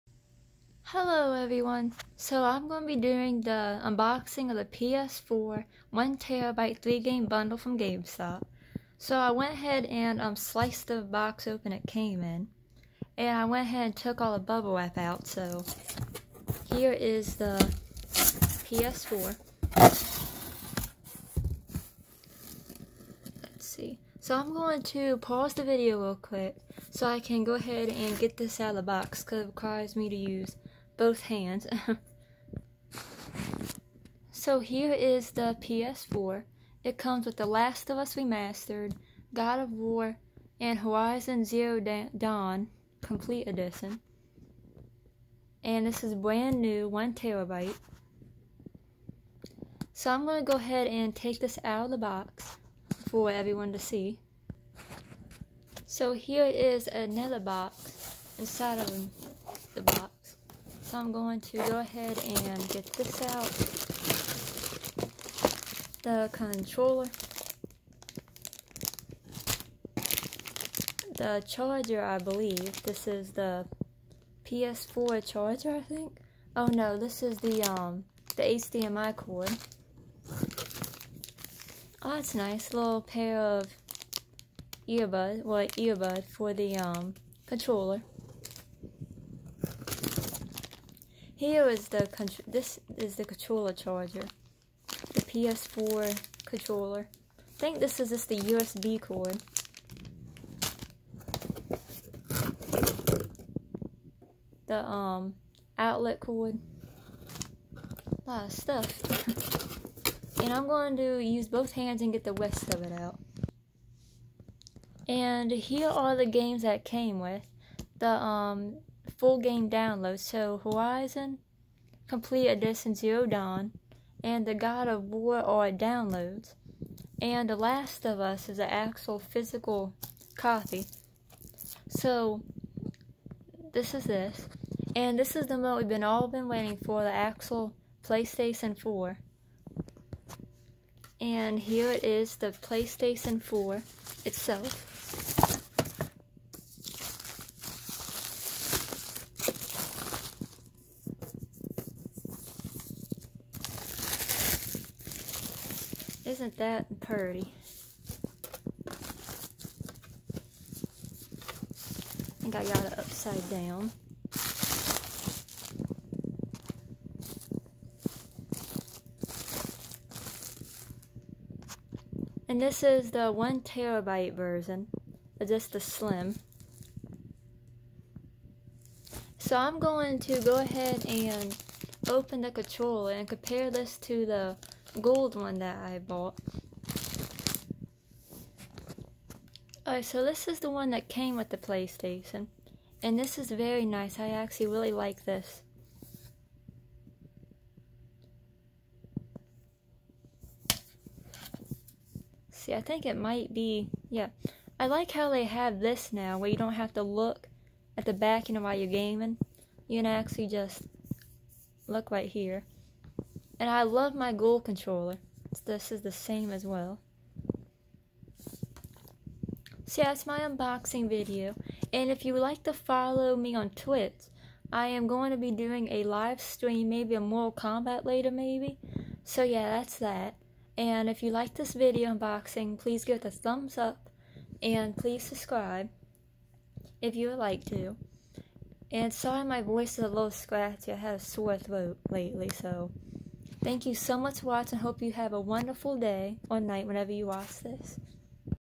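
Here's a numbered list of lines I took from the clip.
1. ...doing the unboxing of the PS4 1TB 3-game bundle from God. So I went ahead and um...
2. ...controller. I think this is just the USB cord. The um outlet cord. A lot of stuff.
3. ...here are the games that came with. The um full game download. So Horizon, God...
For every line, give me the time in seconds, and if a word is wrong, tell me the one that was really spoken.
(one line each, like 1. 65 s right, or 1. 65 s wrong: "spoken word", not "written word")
1. 2 s wrong: "GameStop", not "God"
2. 96 s right
3. 115 s wrong: "Complete", not "God".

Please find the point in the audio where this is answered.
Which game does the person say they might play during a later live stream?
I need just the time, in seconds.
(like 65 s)
227 s.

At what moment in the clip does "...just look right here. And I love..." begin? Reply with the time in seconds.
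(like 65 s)
210 s.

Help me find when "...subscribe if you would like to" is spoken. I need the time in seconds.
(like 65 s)
235 s.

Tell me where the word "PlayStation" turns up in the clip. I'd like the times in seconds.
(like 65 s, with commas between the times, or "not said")
138 s, 142 s, 191 s.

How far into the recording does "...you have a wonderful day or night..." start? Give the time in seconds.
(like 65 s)
245 s.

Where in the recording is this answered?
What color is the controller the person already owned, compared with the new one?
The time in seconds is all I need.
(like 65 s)
184 s.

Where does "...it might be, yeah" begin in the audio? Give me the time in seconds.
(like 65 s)
203 s.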